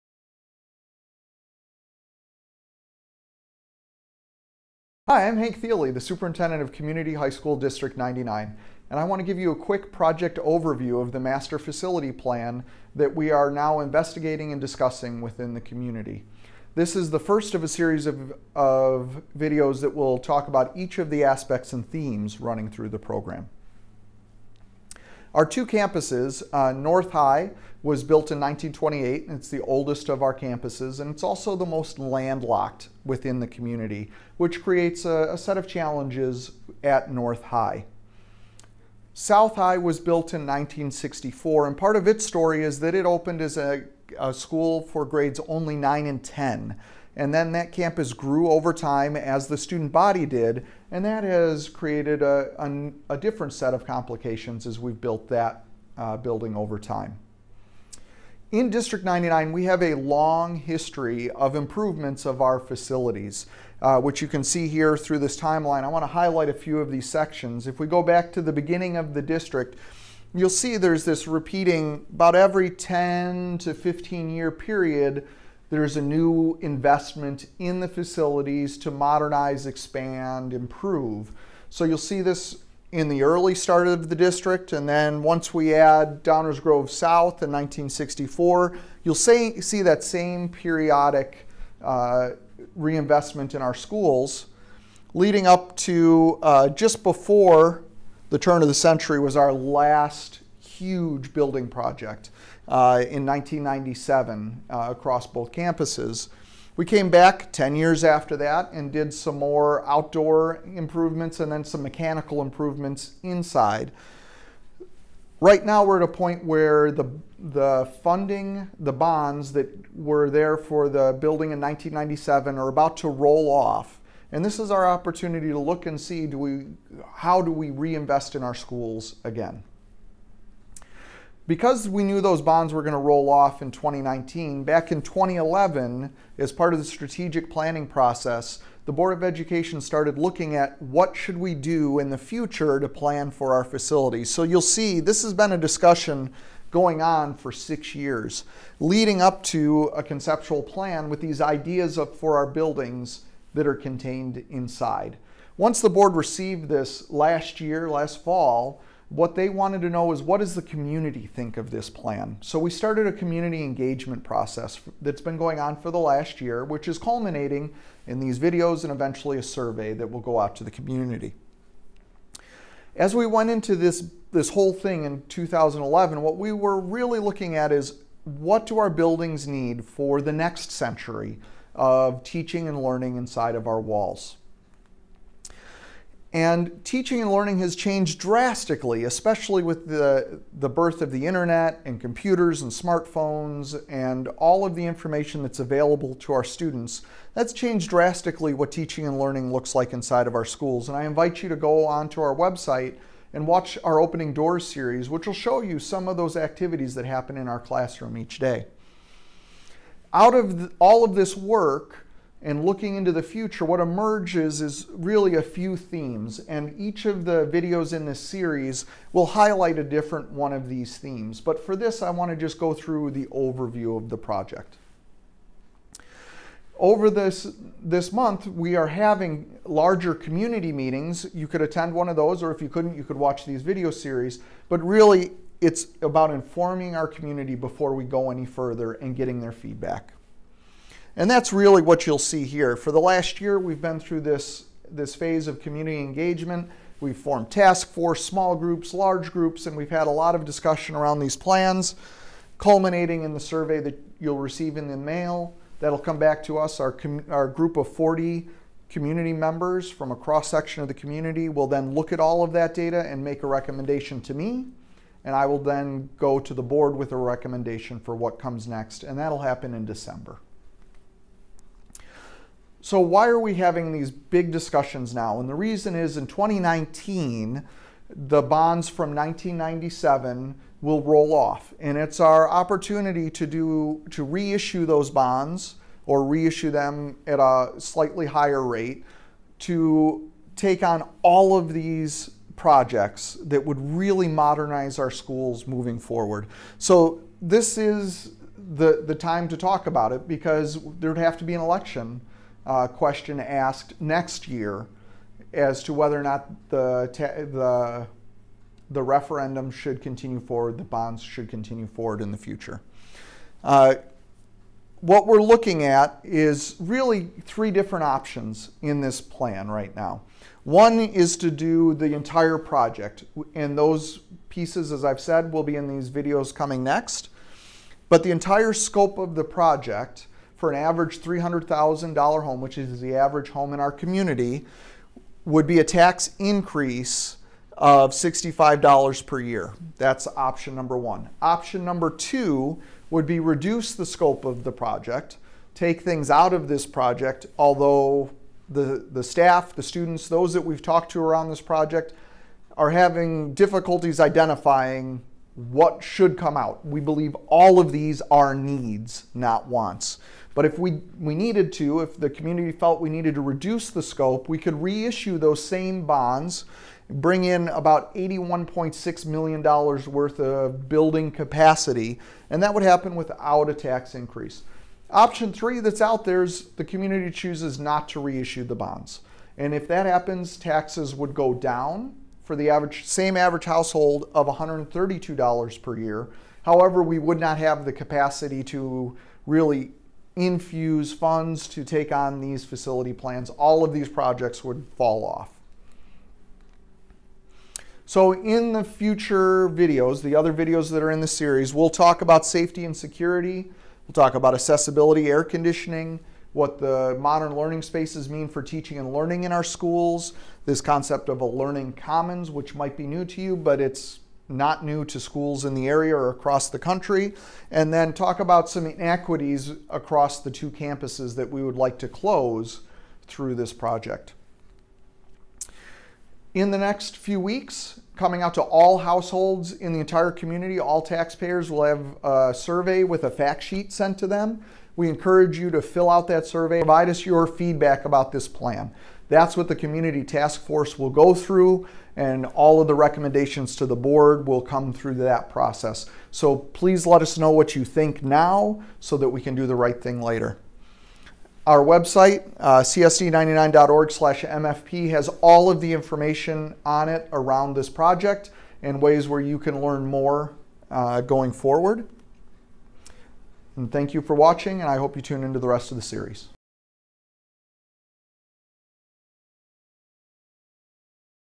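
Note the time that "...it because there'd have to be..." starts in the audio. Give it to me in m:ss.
5:00.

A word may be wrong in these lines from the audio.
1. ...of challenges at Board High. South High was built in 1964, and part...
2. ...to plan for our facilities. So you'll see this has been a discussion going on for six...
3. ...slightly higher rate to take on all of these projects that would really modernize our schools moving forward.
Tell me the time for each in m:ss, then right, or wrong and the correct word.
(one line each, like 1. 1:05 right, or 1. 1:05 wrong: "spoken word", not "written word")
1. 0:35 wrong: "North", not "Board"
2. 2:22 right
3. 4:47 right.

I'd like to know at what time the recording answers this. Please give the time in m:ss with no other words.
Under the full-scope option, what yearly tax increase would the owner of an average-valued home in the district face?
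5:38.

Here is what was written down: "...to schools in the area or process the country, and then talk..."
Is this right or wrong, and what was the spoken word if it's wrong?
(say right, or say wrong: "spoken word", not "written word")
wrong: "across", not "process".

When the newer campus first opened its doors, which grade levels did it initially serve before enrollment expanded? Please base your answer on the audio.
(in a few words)
9 and 10.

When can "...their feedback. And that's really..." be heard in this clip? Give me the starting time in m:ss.
3:59.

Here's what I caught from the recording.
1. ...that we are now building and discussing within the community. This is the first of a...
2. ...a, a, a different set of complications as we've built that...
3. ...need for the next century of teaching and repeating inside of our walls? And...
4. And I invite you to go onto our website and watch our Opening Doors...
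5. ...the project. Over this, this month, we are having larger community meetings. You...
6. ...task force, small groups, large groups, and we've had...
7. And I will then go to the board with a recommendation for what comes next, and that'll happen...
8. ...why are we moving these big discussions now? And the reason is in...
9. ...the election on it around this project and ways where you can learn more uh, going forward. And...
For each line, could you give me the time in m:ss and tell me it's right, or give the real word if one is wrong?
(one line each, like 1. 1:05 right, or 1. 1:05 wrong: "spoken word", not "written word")
1. 0:12 wrong: "investigating", not "building"
2. 0:52 right
3. 2:59 wrong: "learning", not "repeating"
4. 3:20 right
5. 3:44 right
6. 4:07 right
7. 4:25 right
8. 4:32 wrong: "having", not "moving"
9. 7:35 wrong: "information", not "election".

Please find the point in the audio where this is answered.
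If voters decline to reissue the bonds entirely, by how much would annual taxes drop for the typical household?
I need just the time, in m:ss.
6:24.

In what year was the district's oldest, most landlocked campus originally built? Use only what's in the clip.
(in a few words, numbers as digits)
1928.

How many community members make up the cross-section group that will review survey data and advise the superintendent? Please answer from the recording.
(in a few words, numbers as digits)
40.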